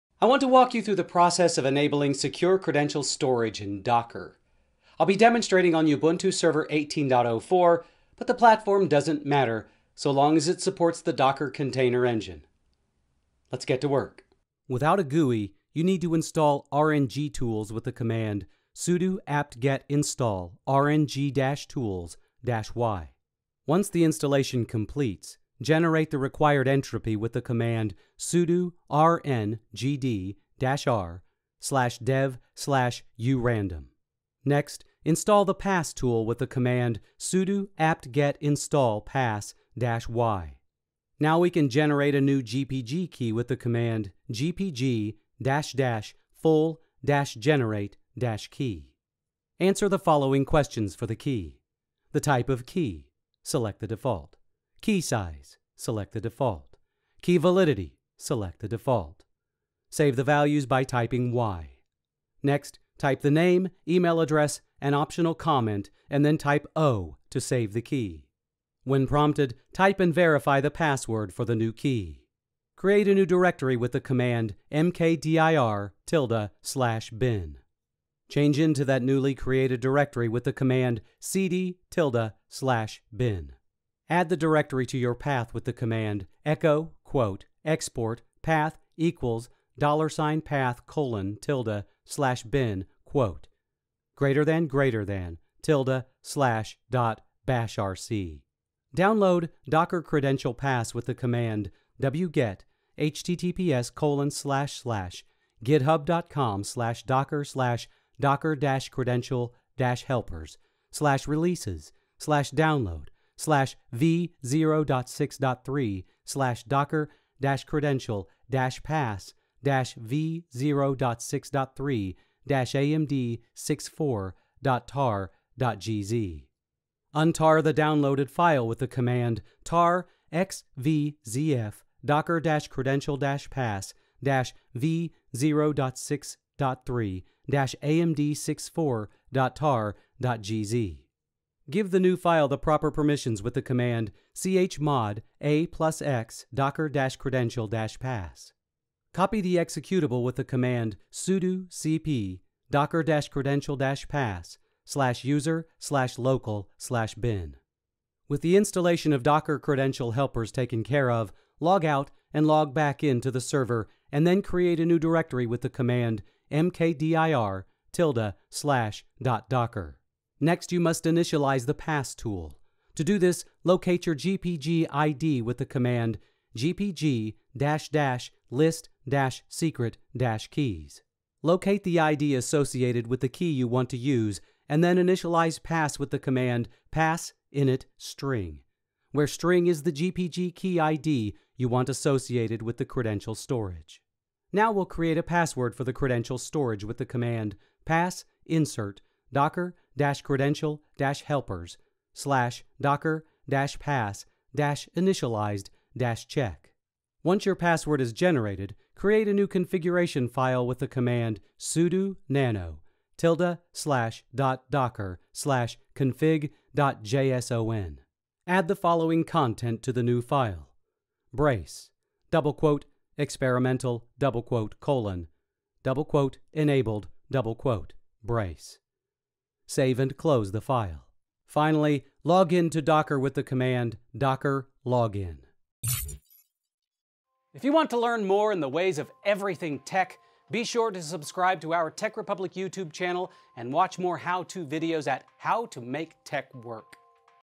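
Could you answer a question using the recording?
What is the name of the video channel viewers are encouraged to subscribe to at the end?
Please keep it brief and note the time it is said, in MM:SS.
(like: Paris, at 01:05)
Tech Republic, at 04:01.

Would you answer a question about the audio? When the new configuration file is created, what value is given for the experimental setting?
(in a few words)
enabled.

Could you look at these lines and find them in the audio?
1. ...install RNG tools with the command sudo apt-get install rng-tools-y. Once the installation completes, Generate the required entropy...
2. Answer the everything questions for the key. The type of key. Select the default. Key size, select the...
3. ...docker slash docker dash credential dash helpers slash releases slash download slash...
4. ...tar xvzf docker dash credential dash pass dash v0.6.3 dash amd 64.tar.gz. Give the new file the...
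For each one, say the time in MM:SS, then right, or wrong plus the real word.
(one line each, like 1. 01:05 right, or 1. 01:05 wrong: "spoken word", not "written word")
1. 00:16 right
2. 00:49 wrong: "following", not "everything"
3. 01:47 right
4. 02:09 right.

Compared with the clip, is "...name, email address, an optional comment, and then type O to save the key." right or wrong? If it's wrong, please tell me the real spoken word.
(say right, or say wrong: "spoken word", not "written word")
right.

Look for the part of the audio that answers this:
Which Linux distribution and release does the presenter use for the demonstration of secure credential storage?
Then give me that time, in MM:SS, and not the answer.
00:05.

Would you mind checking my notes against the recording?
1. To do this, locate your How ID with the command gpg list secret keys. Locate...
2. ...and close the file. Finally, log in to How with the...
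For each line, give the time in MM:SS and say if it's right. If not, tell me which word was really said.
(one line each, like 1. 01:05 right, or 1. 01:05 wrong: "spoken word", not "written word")
1. 02:52 wrong: "GPG", not "How"
2. 03:49 wrong: "Docker", not "How".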